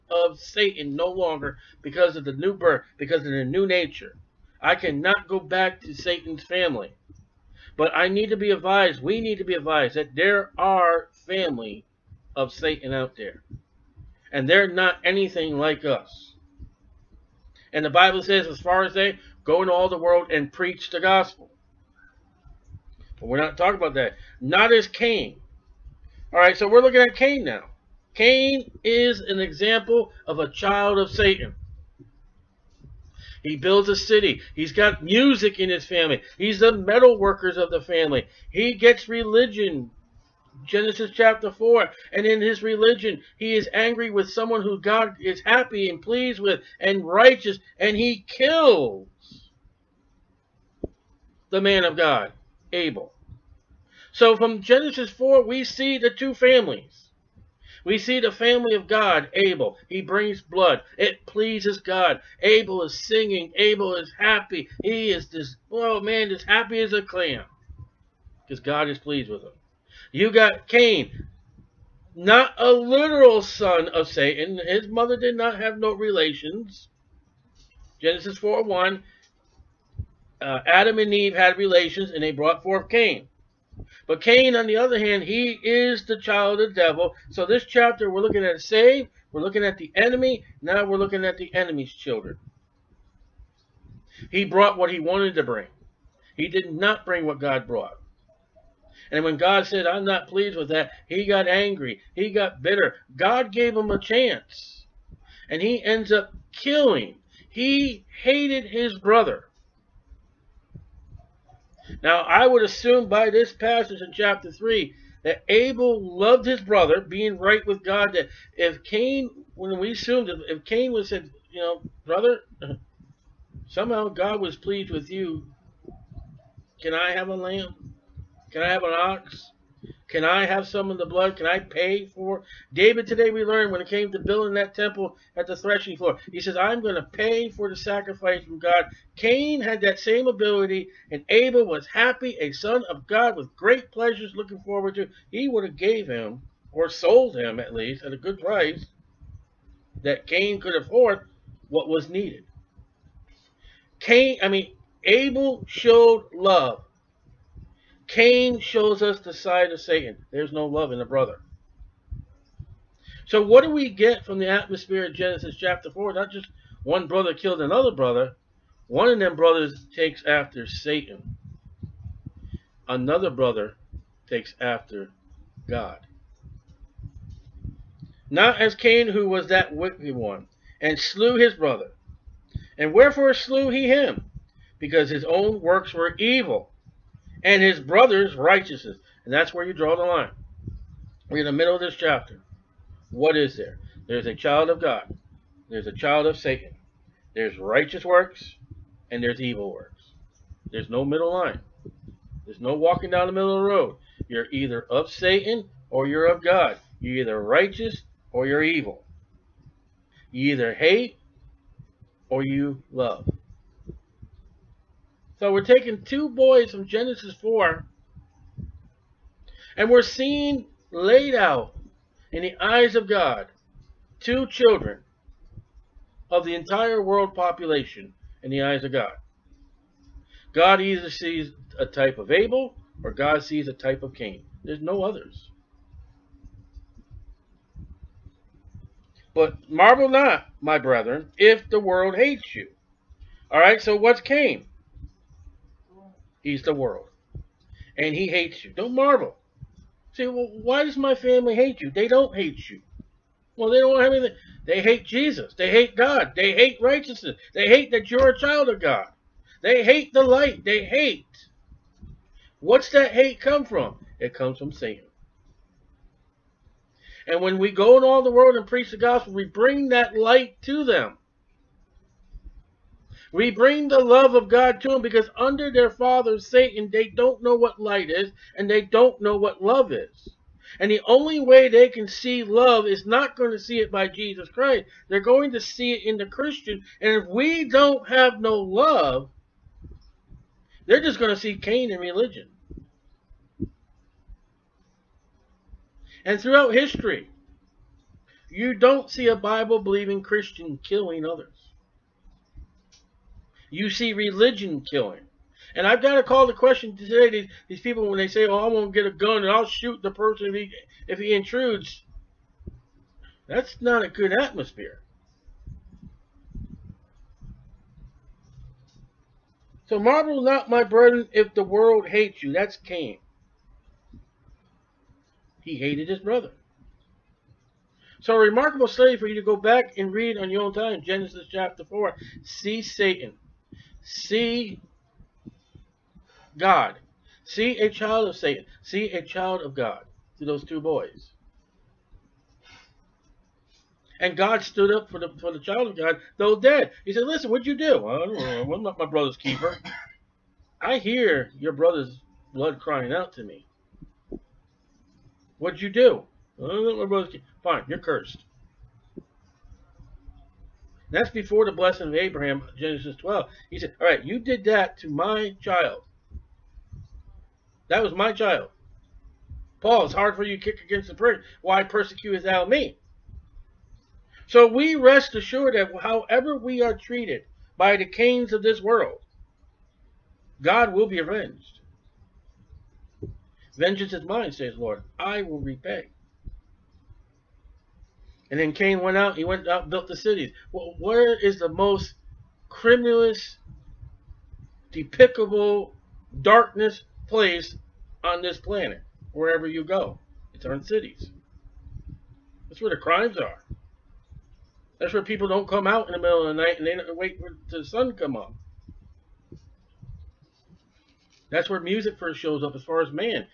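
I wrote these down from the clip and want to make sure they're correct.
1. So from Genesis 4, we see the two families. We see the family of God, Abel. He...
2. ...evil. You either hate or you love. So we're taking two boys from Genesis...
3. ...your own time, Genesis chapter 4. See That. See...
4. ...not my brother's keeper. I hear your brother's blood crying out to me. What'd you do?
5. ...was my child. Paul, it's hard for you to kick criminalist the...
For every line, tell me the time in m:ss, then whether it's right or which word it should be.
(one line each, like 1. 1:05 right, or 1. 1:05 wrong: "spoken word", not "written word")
1. 0:54 right
2. 3:28 right
3. 5:30 wrong: "Satan", not "That"
4. 5:48 right
5. 6:08 wrong: "against", not "criminalist".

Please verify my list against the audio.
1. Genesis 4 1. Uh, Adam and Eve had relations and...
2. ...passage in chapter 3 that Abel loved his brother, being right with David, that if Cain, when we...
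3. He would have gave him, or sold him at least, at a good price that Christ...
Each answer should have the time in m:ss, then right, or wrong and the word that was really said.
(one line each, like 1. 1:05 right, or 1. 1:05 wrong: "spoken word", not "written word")
1. 1:18 right
2. 1:53 wrong: "God", not "David"
3. 2:25 wrong: "Cain", not "Christ".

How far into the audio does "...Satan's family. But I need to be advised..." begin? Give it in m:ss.
0:05.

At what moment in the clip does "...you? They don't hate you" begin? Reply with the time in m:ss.
4:11.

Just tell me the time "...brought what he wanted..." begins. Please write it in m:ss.
1:34.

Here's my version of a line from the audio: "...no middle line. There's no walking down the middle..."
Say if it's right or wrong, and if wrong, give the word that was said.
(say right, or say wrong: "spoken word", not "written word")
right.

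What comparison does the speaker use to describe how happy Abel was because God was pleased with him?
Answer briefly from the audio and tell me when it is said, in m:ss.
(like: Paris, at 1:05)
happy as a clam, at 1:06.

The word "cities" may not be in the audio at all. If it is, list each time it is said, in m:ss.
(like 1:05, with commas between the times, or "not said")
6:30, 6:40.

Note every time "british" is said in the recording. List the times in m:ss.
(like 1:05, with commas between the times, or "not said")
not said.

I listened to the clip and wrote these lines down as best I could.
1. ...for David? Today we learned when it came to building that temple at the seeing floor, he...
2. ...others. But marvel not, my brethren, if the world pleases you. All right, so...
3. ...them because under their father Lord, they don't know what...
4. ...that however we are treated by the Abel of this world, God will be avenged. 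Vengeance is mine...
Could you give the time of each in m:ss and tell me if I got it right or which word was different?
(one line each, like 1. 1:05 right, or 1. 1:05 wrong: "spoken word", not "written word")
1. 2:12 wrong: "threshing", not "seeing"
2. 3:55 wrong: "hates", not "pleases"
3. 4:34 wrong: "Satan", not "Lord"
4. 6:15 wrong: "Cains", not "Abel".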